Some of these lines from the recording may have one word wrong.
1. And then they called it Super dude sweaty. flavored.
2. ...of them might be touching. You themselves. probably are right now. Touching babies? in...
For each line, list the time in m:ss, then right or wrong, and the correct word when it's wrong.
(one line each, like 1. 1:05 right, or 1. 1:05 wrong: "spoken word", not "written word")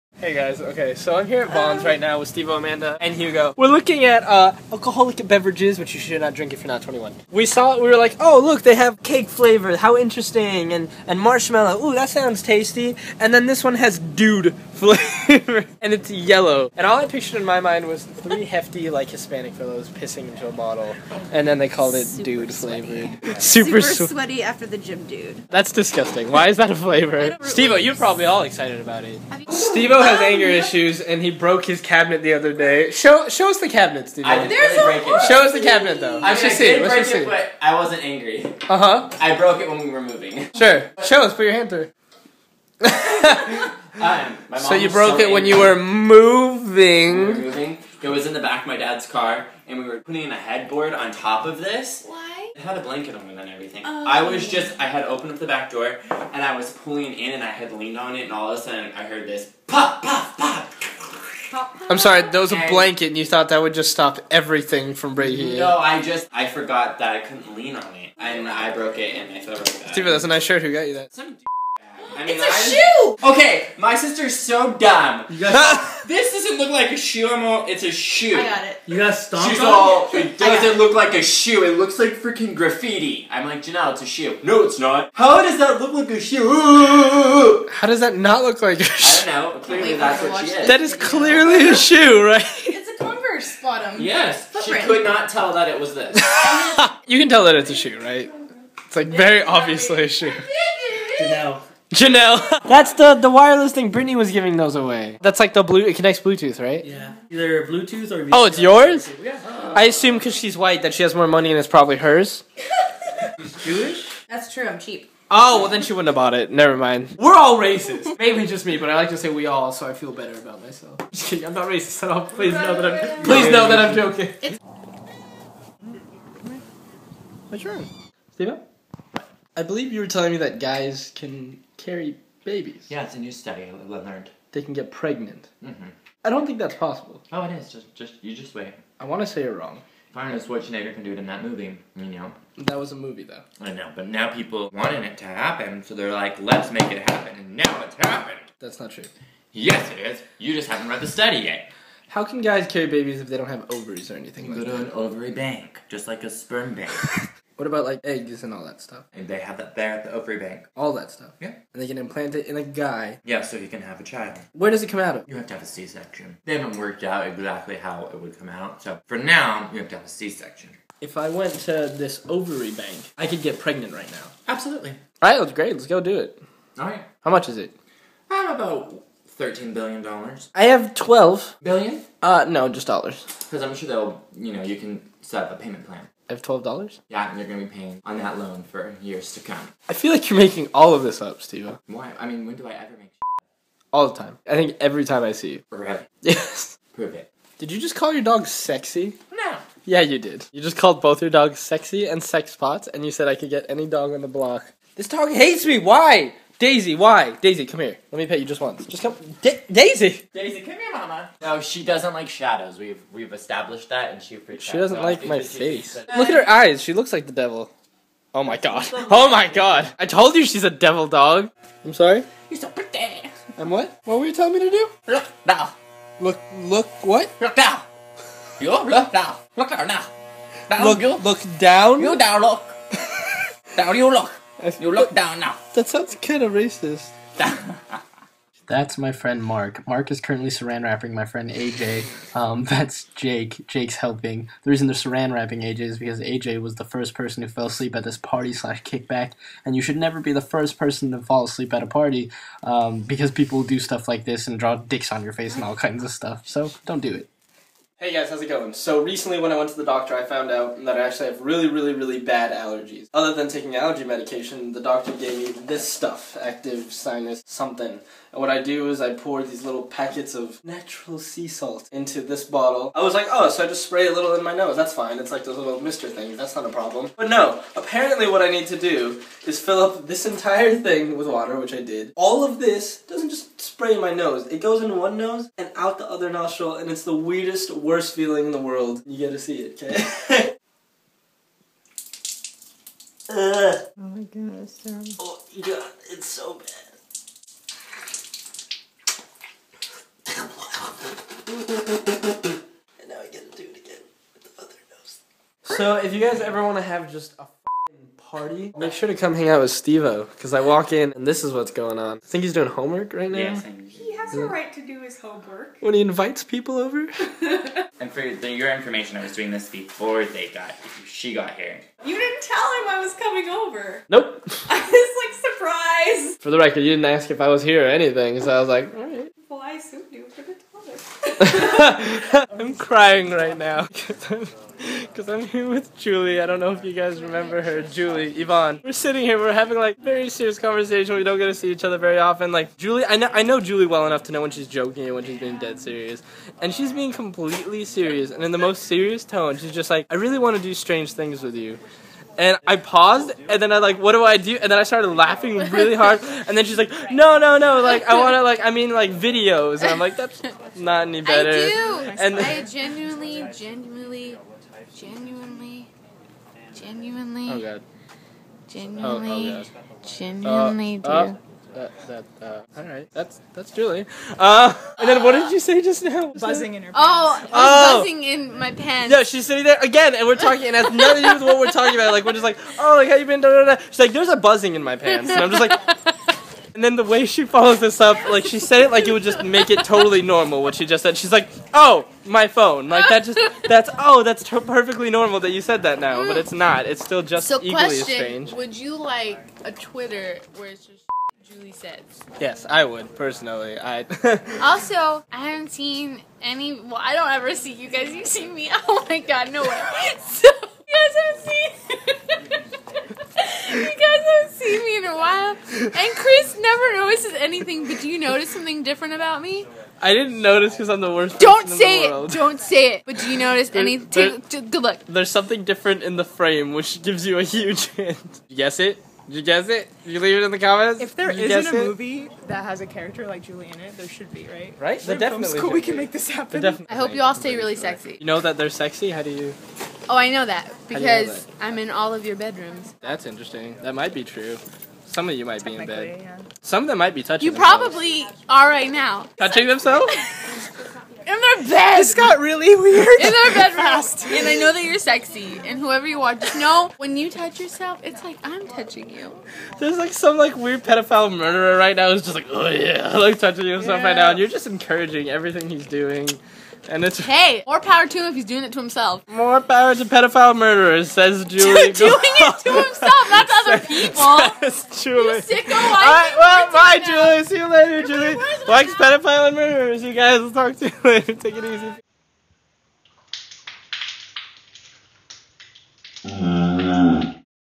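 1. 0:21 right
2. 7:26 wrong: "themselves", not "babies".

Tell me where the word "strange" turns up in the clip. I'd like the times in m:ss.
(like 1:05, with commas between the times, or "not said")
5:50, 6:38.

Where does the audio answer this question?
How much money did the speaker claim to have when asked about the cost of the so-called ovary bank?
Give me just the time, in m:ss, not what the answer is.
3:00.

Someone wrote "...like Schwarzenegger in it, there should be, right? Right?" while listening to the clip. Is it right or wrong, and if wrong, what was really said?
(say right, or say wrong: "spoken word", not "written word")
wrong: "Julie", not "Schwarzenegger".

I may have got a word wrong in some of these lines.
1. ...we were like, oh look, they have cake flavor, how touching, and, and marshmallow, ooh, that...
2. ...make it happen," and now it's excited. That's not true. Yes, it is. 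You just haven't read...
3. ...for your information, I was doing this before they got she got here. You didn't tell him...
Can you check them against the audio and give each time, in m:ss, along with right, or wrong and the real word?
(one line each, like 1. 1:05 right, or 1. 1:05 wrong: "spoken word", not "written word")
1. 0:07 wrong: "interesting", not "touching"
2. 2:26 wrong: "happened", not "excited"
3. 5:18 right.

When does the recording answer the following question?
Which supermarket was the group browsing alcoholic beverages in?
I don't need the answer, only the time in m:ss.
0:01.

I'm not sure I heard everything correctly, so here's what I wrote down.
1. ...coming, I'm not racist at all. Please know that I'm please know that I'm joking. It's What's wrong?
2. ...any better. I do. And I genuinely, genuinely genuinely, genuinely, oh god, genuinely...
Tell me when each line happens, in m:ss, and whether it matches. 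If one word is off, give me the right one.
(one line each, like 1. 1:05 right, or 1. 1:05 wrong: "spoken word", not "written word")
1. 2:01 wrong: "kidding", not "coming"
2. 6:01 right.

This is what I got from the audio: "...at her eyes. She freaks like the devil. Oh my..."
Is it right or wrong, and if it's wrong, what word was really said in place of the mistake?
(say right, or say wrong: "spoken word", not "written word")
wrong: "looks", not "freaks".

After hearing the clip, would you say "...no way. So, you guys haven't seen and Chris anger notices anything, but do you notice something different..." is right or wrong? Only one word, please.
wrong.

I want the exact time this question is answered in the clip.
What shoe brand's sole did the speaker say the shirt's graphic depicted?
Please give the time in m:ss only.
1:33.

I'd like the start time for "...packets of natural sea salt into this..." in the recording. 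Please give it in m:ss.
4:29.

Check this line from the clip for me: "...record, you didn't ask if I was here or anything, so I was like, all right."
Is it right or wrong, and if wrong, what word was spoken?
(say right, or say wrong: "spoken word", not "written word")
right.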